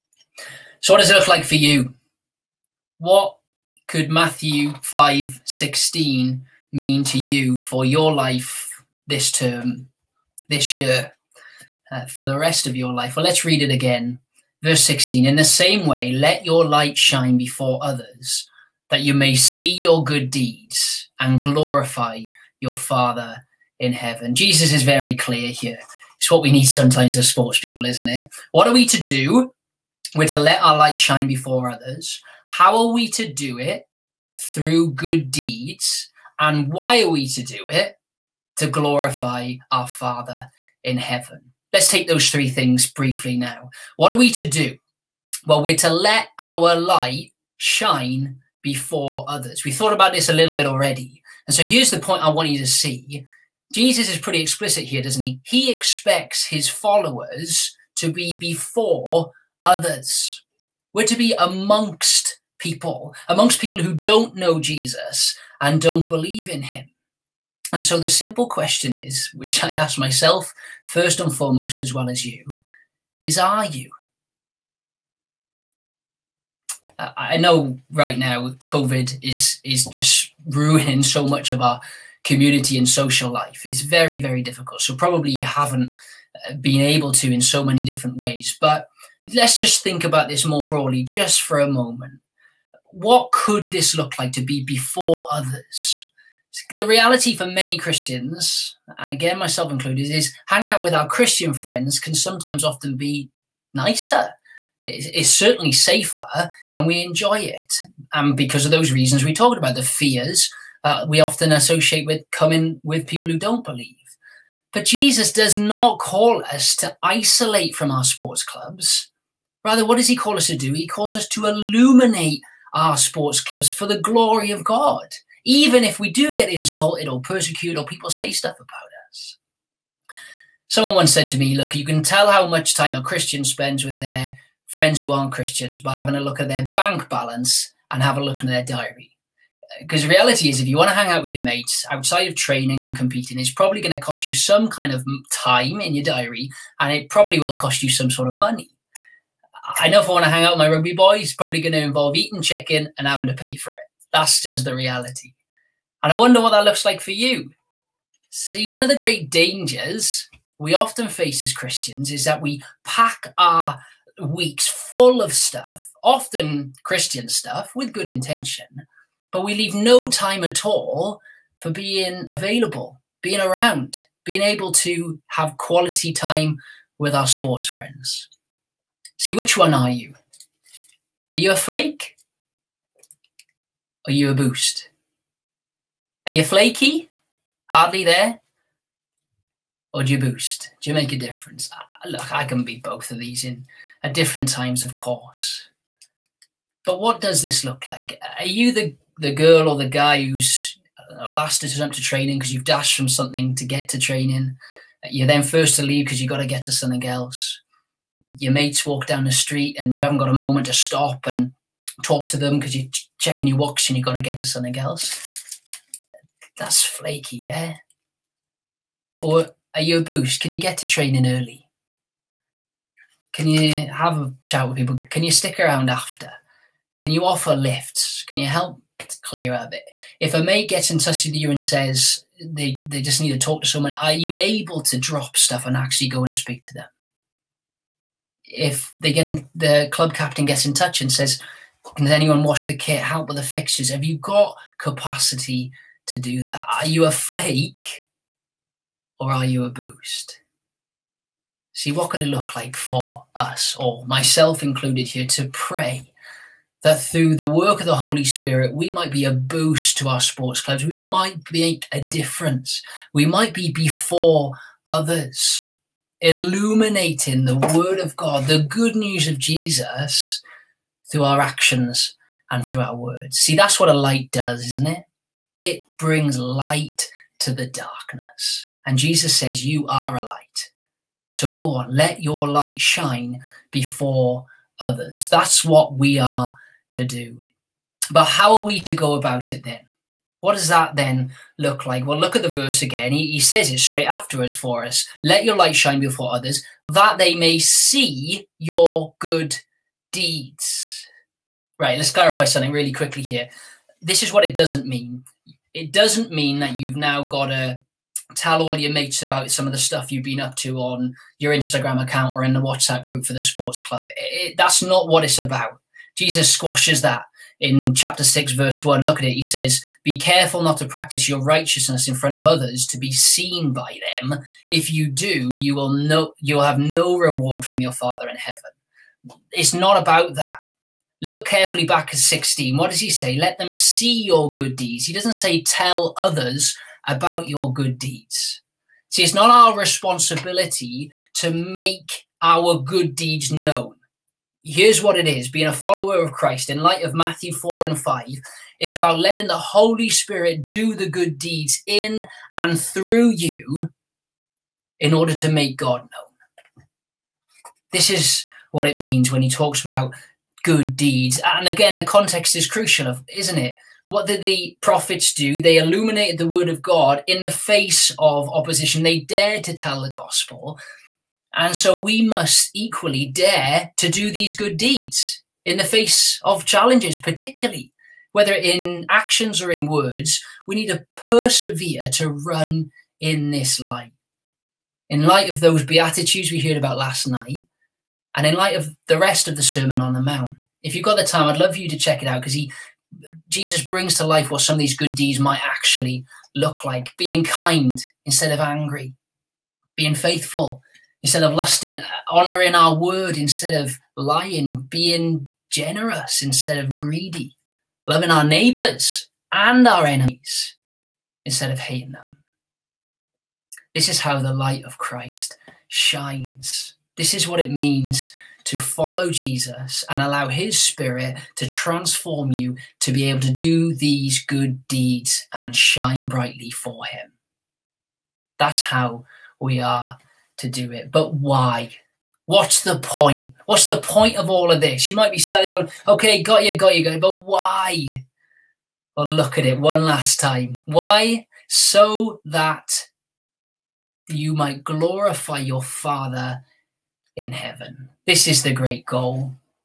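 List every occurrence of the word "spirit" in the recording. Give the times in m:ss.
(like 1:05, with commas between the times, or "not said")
4:18, 5:50, 7:00.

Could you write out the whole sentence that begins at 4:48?
But how are we to go about it then?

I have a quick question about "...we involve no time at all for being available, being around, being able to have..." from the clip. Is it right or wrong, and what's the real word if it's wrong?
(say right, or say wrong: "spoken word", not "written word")
wrong: "leave", not "involve".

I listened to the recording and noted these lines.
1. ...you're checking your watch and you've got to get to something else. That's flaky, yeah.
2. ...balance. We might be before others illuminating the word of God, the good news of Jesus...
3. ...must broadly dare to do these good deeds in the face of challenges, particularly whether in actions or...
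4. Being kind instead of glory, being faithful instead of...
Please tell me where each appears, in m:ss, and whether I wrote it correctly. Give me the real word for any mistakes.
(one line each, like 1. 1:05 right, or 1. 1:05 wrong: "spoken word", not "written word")
1. 3:32 right
2. 4:21 wrong: "difference", not "balance"
3. 6:12 wrong: "equally", not "broadly"
4. 6:37 wrong: "angry", not "glory".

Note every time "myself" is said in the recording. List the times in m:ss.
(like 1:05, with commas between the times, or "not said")
1:09, 1:39, 4:14.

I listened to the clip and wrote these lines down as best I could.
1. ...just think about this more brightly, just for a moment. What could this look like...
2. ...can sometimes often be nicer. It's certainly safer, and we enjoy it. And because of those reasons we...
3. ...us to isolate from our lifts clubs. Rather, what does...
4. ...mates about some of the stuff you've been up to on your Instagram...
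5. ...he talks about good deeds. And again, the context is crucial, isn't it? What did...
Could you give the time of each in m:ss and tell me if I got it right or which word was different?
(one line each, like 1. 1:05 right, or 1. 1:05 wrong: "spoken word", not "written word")
1. 1:29 wrong: "broadly", not "brightly"
2. 1:41 right
3. 1:56 wrong: "sports", not "lifts"
4. 5:08 right
5. 5:59 right.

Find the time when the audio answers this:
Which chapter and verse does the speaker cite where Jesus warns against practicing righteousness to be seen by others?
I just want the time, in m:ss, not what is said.
5:17.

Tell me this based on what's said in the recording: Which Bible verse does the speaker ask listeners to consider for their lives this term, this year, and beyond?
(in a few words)
Matthew 5:16.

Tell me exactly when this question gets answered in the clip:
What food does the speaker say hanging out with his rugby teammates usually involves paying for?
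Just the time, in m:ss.
2:32.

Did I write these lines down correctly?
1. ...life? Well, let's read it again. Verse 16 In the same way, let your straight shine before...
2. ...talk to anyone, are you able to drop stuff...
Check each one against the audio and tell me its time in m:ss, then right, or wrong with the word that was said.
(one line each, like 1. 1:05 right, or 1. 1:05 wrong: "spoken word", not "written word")
1. 0:12 wrong: "light", not "straight"
2. 3:53 wrong: "someone", not "anyone".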